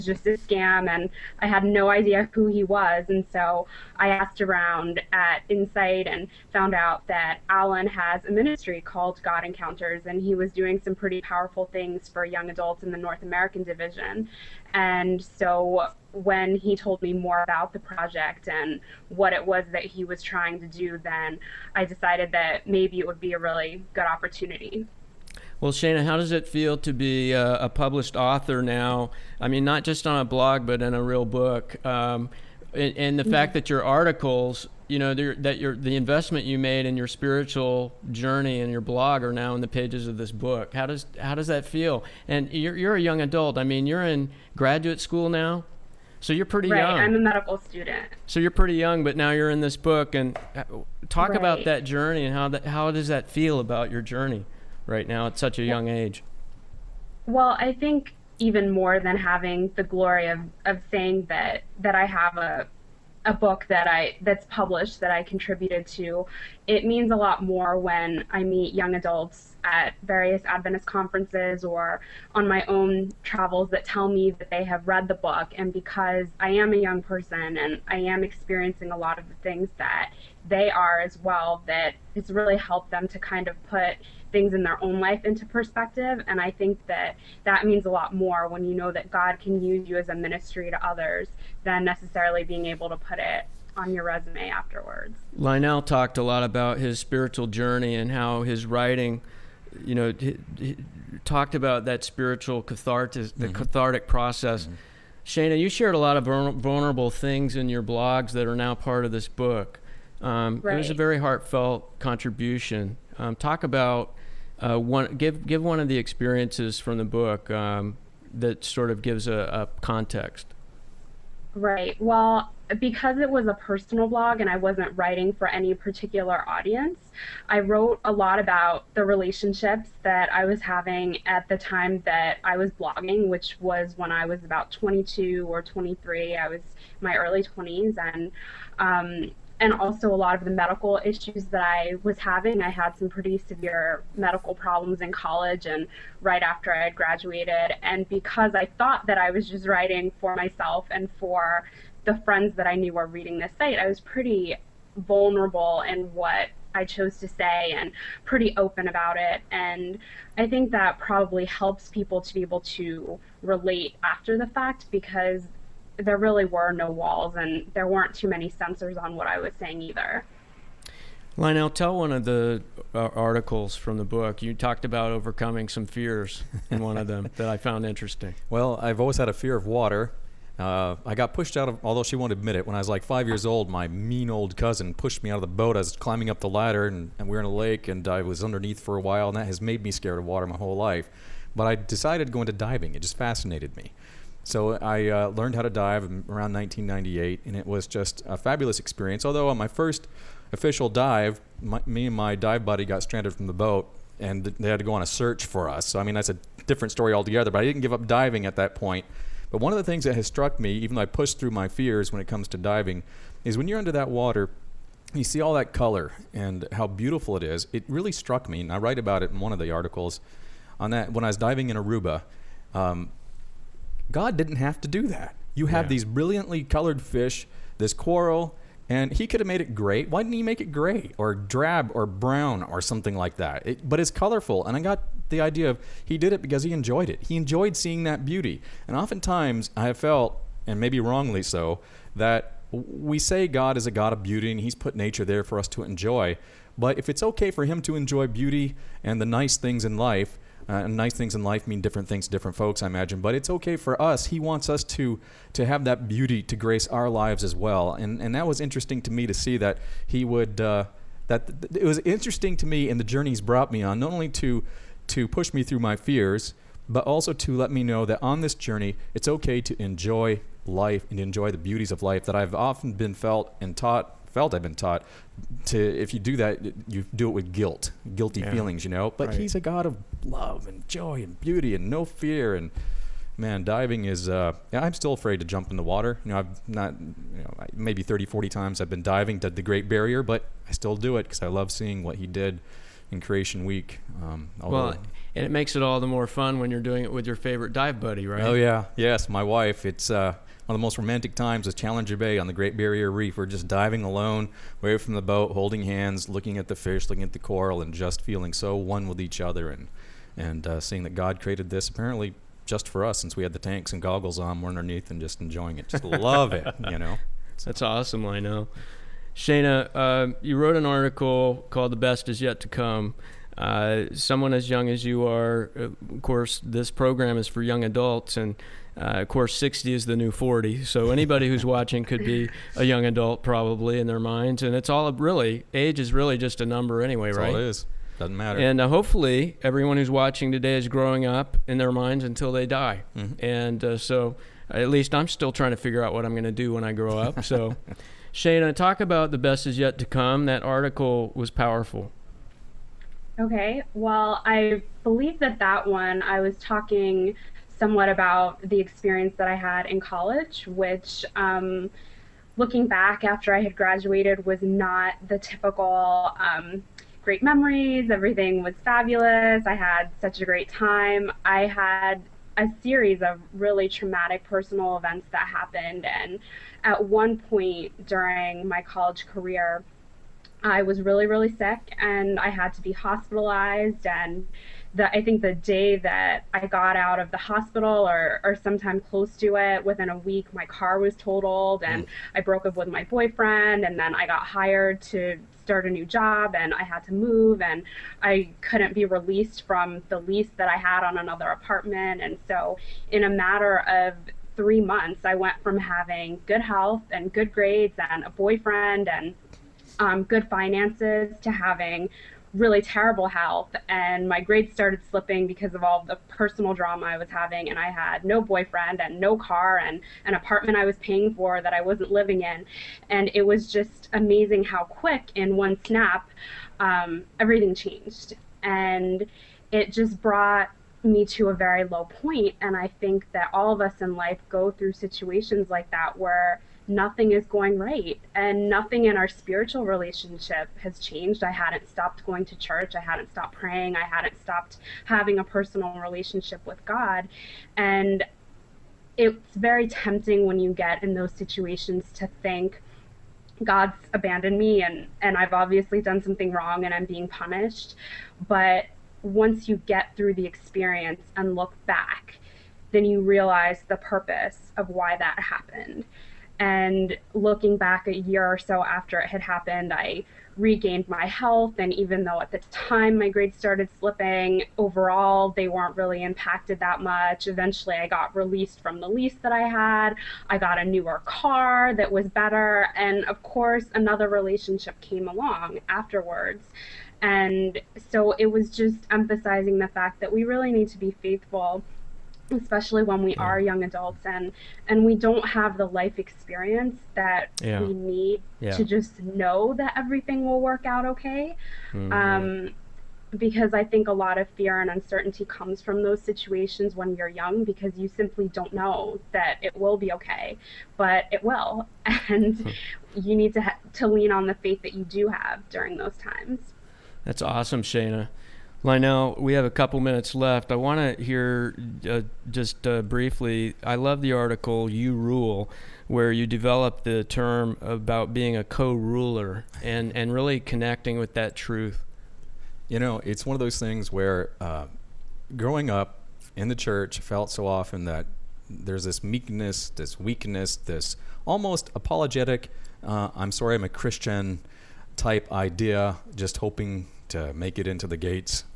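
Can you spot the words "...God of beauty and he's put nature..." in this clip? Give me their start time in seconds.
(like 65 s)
243 s.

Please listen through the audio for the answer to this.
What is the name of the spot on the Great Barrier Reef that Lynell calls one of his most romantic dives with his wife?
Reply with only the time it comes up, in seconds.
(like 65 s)
301 s.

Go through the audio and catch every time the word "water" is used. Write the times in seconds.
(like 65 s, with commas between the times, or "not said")
179 s, 190 s, 214 s, 285 s.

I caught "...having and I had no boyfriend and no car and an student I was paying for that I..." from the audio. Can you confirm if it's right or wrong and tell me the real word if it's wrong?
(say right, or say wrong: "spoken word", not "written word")
wrong: "apartment", not "student".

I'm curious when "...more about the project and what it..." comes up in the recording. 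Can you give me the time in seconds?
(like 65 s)
17 s.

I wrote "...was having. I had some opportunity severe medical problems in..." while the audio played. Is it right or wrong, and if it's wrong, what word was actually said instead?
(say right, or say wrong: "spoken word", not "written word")
wrong: "pretty", not "opportunity".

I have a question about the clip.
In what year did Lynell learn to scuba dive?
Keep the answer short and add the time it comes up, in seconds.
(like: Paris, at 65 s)
1998, at 196 s.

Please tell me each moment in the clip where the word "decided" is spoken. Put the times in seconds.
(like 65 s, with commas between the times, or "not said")
21 s, 191 s.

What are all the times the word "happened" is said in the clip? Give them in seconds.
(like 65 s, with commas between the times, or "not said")
375 s, 465 s, 469 s.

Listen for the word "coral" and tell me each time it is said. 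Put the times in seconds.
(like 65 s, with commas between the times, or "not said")
227 s, 307 s.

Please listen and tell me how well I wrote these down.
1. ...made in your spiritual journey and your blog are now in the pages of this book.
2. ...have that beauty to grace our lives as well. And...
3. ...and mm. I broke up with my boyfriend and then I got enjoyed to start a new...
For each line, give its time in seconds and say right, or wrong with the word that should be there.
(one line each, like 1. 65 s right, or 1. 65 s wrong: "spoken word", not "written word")
1. 36 s right
2. 255 s right
3. 391 s wrong: "hired", not "enjoyed".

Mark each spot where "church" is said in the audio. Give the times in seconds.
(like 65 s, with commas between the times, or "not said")
442 s, 536 s.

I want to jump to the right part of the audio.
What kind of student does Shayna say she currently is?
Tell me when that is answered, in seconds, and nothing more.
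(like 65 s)
47 s.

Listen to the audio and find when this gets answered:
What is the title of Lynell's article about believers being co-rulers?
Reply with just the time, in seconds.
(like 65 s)
524 s.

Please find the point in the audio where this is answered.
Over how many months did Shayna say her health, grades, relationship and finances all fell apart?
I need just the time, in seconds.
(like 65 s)
404 s.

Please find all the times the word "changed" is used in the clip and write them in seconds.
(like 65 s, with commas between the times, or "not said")
427 s, 440 s.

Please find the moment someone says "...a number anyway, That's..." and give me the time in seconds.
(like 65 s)
336 s.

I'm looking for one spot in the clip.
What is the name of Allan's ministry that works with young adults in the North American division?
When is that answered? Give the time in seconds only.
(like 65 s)
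9 s.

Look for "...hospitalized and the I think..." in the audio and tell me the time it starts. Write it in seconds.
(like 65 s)
382 s.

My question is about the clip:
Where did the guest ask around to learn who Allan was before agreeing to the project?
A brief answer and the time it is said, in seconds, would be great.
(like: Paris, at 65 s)
Insight, at 5 s.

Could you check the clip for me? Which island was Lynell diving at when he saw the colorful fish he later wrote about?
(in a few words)
Aruba.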